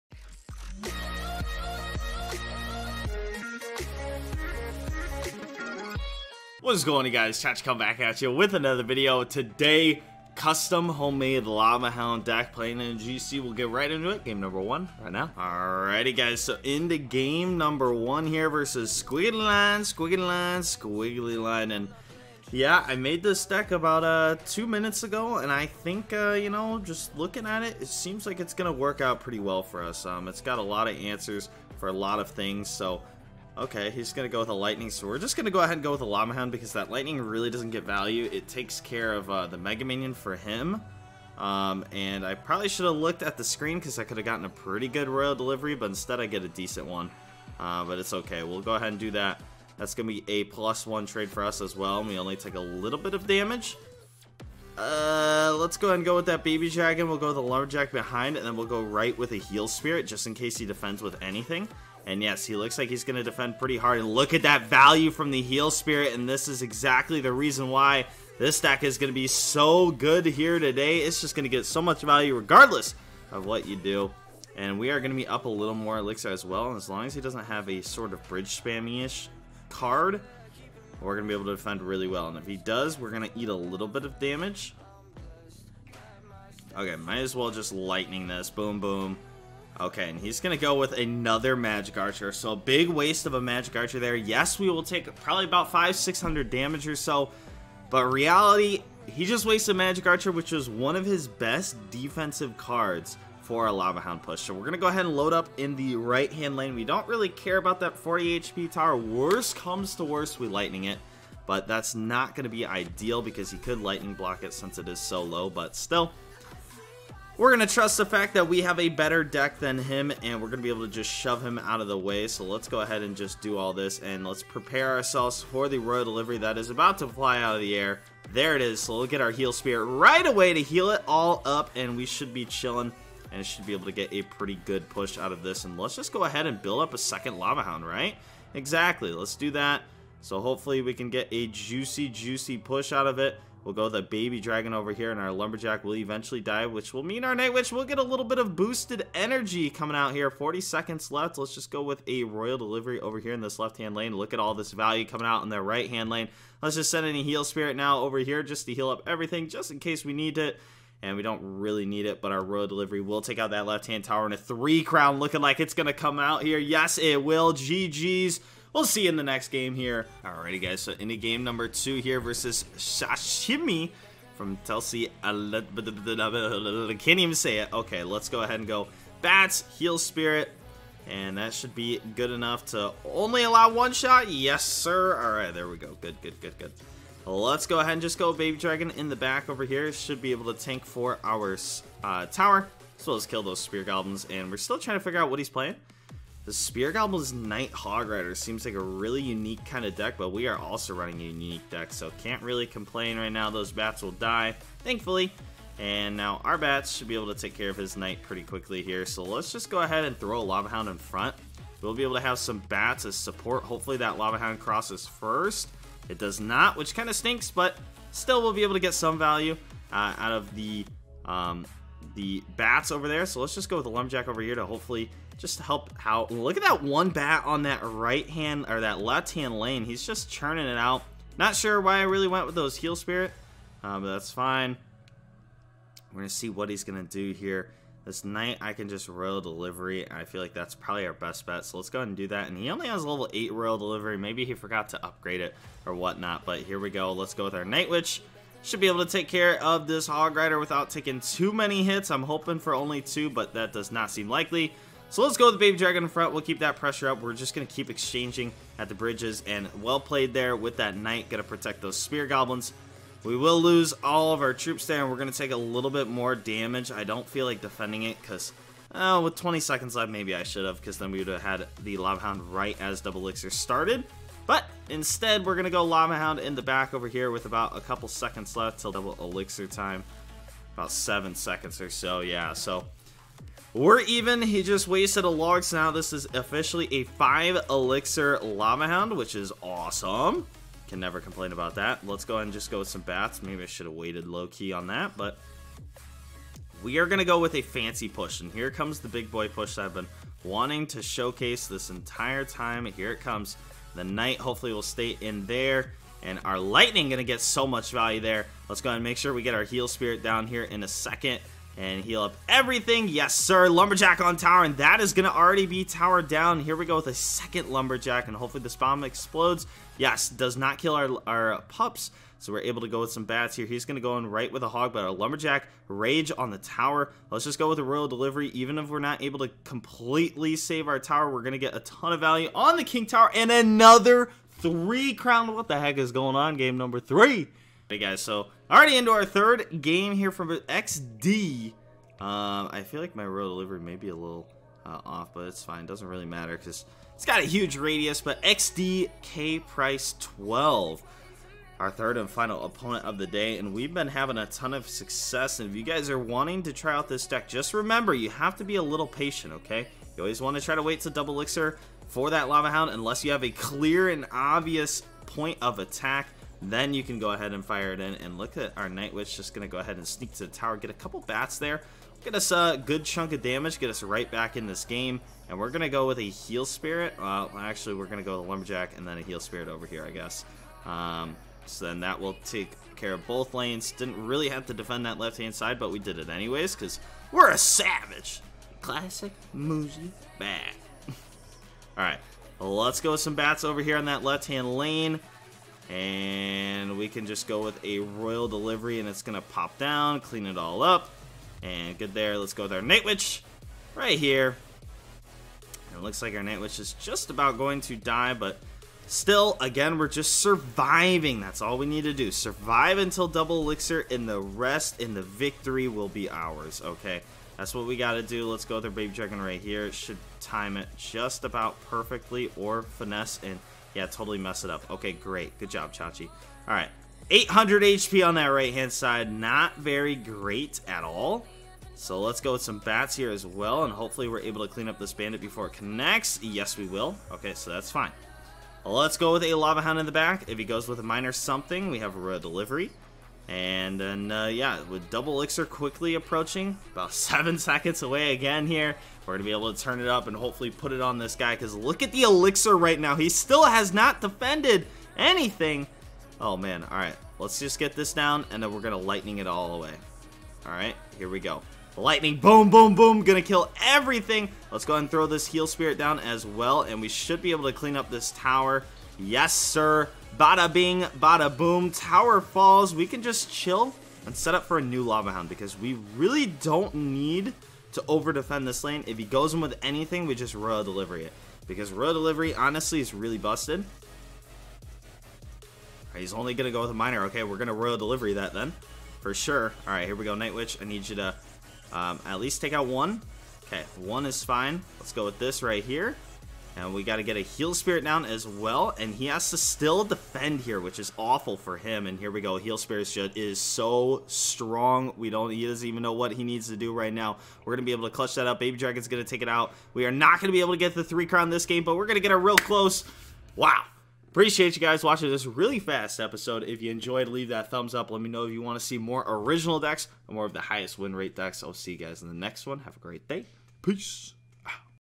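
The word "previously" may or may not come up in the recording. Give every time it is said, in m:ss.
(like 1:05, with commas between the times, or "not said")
not said.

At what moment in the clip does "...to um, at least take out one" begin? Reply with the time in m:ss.
8:11.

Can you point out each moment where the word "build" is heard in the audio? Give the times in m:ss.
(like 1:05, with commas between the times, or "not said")
2:16.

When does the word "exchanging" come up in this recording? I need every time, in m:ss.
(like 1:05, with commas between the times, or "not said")
4:17.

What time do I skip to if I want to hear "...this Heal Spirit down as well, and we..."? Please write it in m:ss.
7:45.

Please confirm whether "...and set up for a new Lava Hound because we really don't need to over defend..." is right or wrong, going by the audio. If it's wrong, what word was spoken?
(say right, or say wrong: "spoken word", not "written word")
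right.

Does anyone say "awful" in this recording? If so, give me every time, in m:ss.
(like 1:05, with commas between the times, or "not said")
8:21.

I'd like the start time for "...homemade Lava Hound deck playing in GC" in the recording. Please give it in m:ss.
0:10.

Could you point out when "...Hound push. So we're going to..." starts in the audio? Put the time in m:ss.
1:43.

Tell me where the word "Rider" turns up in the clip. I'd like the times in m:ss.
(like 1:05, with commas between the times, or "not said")
3:18, 4:10.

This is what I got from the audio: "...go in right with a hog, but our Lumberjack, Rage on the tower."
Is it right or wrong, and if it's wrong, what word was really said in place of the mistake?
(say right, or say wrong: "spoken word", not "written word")
right.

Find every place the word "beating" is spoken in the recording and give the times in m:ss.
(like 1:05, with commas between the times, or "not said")
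not said.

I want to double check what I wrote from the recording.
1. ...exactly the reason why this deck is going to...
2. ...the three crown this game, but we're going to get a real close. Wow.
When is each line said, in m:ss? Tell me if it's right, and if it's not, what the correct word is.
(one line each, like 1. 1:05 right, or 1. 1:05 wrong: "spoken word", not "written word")
1. 1:06 right
2. 8:30 right.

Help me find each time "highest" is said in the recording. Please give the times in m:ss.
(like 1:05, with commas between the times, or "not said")
8:40.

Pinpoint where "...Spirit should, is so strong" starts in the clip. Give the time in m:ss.
8:22.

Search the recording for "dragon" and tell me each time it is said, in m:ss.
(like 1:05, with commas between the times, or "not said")
0:56, 2:24, 3:08, 4:15, 6:59, 8:28.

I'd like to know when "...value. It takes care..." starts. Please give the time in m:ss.
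0:37.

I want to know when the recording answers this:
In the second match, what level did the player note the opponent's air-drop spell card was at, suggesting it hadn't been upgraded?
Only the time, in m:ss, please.
4:03.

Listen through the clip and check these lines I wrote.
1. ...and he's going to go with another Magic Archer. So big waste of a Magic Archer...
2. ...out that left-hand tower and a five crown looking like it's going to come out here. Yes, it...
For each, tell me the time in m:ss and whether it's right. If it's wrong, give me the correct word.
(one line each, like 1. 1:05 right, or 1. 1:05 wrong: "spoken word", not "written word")
1. 1:30 right
2. 2:43 wrong: "three", not "five".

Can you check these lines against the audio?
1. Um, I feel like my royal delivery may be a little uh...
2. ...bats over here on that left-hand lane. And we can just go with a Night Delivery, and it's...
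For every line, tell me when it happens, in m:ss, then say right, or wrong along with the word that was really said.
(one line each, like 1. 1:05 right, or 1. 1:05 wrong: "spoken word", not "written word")
1. 5:42 right
2. 6:33 wrong: "Royal", not "Night".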